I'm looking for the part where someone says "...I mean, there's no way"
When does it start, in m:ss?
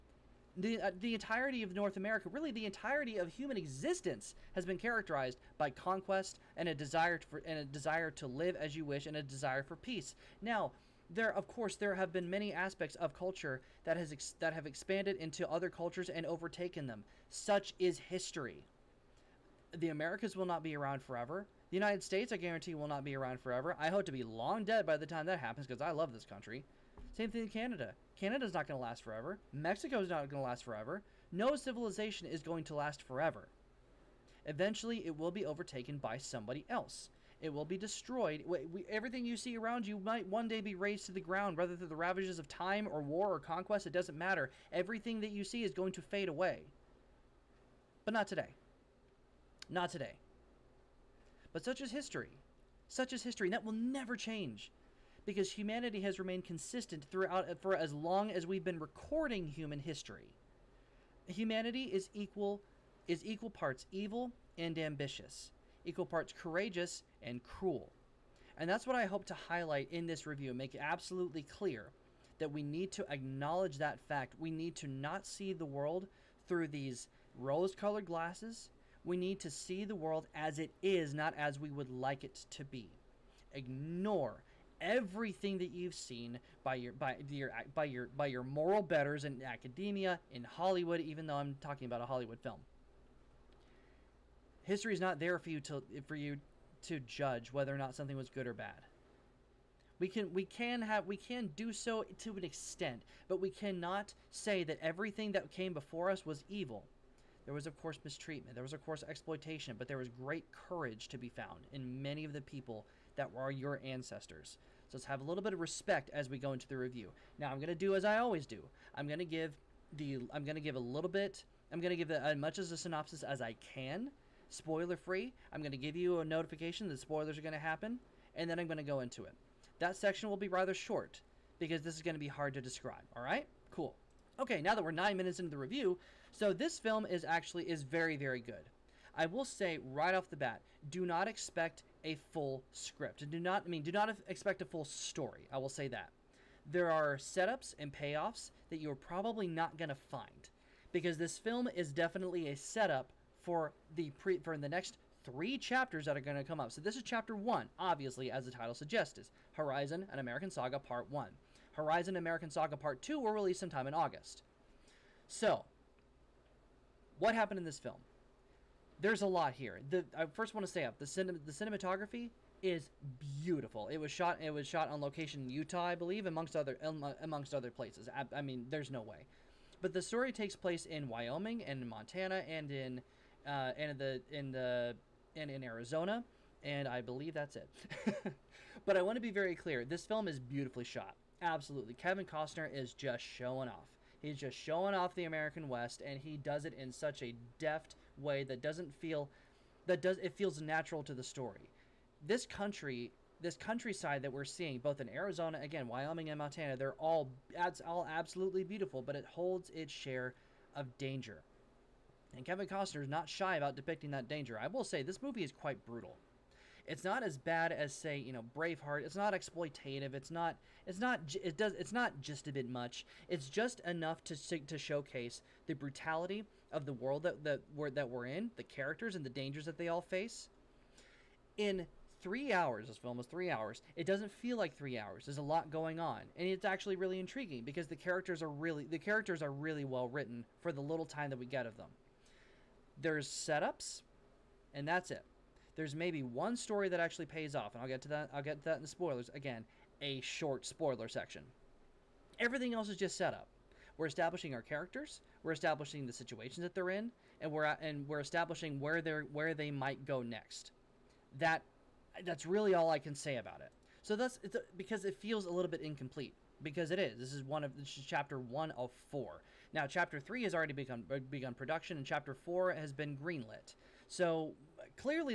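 2:58.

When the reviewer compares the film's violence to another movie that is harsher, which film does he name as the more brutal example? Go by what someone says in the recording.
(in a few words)
Braveheart.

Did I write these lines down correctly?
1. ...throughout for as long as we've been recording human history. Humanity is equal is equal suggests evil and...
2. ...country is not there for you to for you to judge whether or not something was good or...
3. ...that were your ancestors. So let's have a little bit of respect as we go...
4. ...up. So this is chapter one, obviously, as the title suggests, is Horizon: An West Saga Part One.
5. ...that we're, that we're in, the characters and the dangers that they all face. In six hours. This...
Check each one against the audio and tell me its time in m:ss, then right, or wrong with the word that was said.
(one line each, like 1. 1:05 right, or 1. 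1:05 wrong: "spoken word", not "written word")
1. 0:57 wrong: "parts", not "suggests"
2. 1:34 wrong: "history", not "country"
3. 1:53 right
4. 2:36 wrong: "American", not "West"
5. 3:47 wrong: "three", not "six".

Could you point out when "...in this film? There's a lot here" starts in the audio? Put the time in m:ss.
2:47.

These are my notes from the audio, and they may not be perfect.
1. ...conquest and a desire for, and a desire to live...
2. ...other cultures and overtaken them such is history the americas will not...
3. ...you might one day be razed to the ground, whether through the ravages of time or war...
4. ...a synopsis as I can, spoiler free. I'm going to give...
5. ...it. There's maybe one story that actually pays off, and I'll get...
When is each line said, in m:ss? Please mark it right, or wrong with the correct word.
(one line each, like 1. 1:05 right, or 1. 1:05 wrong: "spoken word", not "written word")
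1. 0:05 right
2. 0:15 right
3. 0:39 right
4. 2:02 right
5. 4:05 right.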